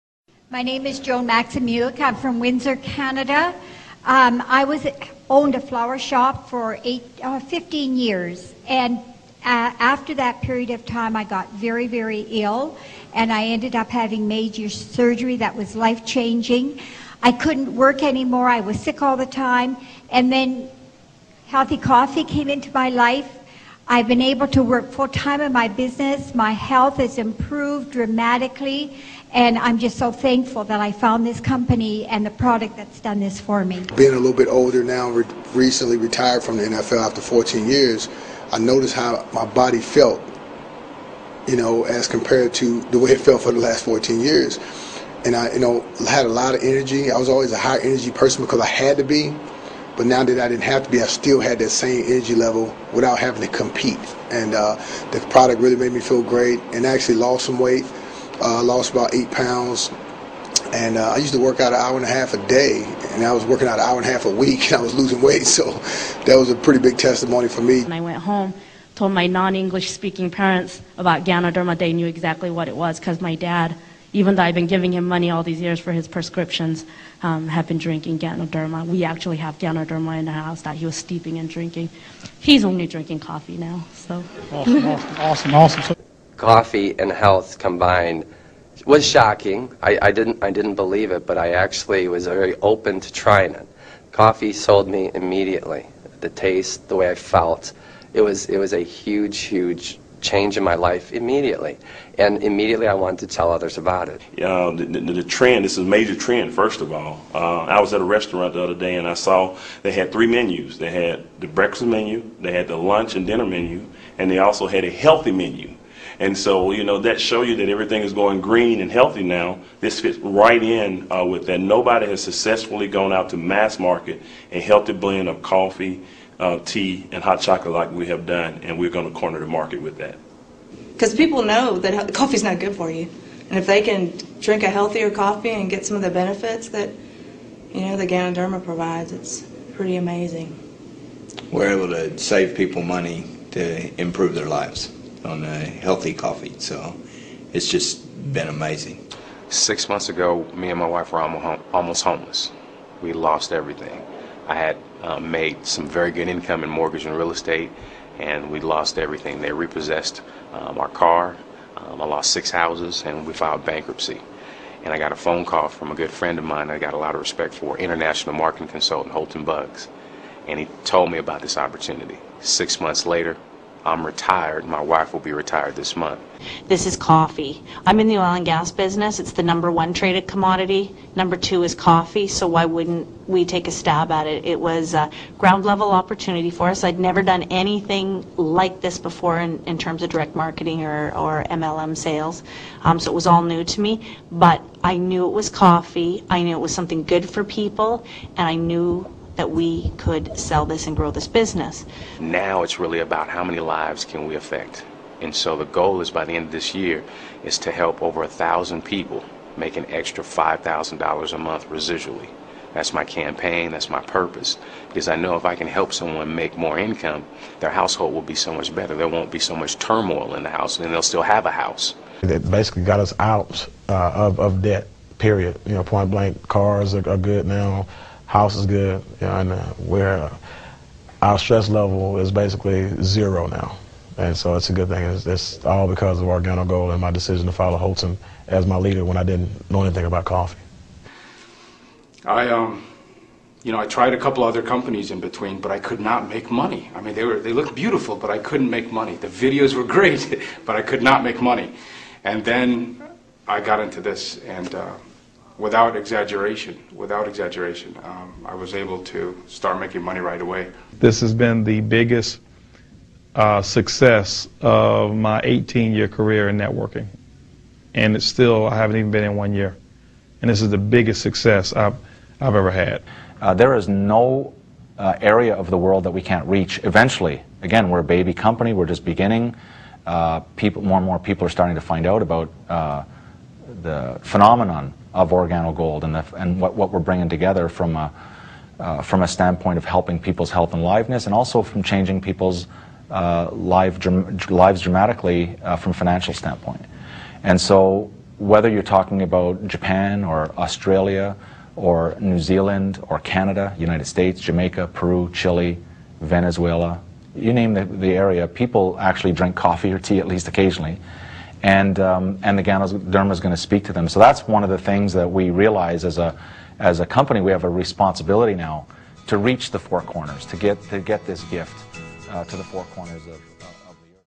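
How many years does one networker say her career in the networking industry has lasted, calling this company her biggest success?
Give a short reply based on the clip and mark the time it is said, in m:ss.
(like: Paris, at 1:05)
18, at 4:25.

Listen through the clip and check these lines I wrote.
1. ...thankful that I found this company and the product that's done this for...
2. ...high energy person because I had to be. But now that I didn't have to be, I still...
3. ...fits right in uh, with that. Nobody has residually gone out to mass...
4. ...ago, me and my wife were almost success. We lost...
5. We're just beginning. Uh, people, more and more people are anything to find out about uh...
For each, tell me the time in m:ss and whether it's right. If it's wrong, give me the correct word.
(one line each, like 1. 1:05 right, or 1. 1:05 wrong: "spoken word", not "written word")
1. 0:30 right
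2. 0:47 right
3. 1:59 wrong: "successfully", not "residually"
4. 2:30 wrong: "homeless", not "success"
5. 4:38 wrong: "starting", not "anything".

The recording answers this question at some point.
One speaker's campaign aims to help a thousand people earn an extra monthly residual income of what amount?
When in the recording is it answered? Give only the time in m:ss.
3:30.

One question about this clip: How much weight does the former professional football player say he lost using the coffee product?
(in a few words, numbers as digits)
8 pounds.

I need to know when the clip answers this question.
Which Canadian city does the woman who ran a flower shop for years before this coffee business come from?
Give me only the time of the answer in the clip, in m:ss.
0:02.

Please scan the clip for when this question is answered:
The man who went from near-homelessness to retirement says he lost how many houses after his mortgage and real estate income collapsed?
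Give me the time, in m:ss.
2:42.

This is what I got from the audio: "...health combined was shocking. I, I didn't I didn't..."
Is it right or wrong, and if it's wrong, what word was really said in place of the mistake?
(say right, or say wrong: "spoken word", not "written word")
right.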